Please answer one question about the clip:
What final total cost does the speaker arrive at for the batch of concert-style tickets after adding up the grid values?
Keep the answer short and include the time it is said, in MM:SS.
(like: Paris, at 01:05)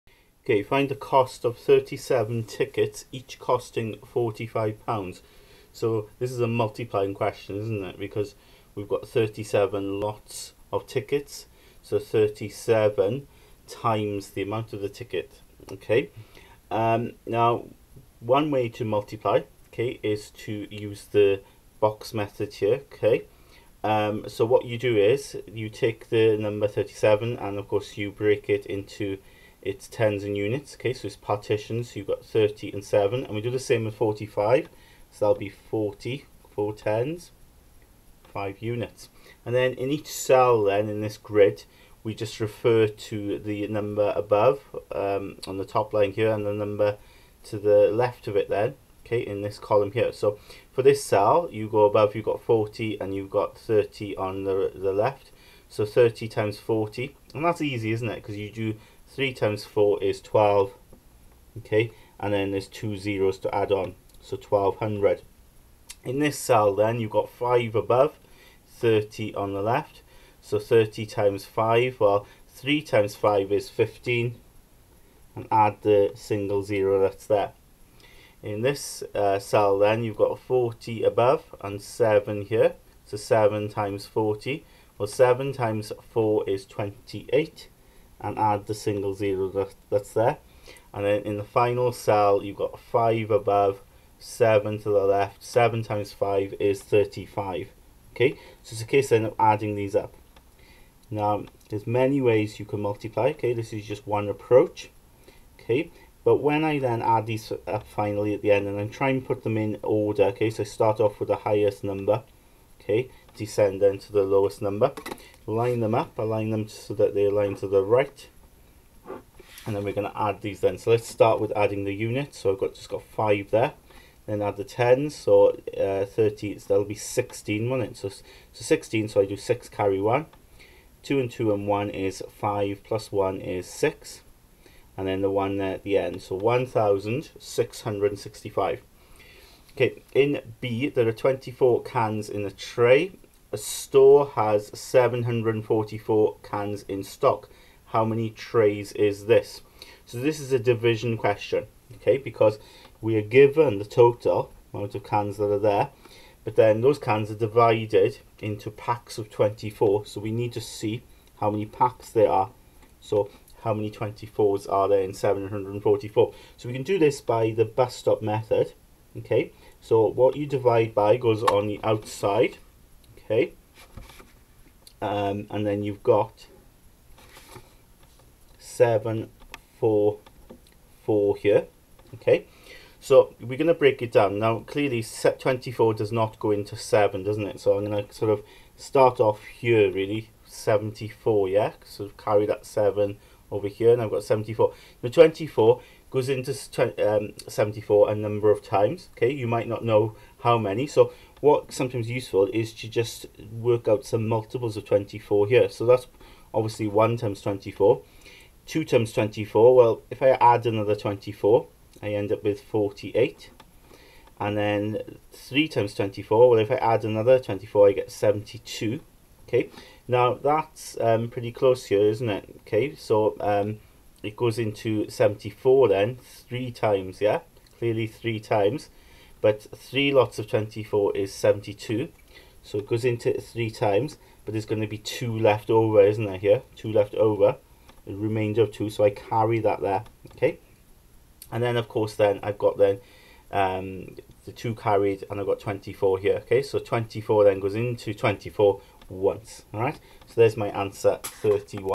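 1665, at 02:16.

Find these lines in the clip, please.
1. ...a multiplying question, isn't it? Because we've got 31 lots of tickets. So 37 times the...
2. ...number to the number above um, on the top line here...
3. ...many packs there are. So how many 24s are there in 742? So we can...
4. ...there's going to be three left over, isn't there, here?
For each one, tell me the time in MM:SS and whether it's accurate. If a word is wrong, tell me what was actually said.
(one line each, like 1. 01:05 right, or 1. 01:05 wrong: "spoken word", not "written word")
1. 00:06 wrong: "37", not "31"
2. 00:42 wrong: "refer", not "number"
3. 02:41 wrong: "744", not "742"
4. 03:54 wrong: "two", not "three".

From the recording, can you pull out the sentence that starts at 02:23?
A store has 744 cans in stock.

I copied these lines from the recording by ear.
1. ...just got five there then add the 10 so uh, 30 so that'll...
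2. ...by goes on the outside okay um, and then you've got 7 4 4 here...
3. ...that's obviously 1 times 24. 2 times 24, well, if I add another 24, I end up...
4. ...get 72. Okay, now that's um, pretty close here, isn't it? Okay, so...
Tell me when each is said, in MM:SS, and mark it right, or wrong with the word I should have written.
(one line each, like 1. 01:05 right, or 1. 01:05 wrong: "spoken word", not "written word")
1. 02:02 right
2. 02:50 right
3. 03:25 right
4. 03:37 right.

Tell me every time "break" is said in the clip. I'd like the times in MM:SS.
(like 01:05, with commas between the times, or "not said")
00:28, 03:03.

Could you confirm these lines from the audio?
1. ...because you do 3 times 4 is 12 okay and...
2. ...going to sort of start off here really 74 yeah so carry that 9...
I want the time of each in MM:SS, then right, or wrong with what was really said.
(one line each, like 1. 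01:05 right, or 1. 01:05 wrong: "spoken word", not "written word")
1. 00:58 right
2. 03:07 wrong: "7", not "9".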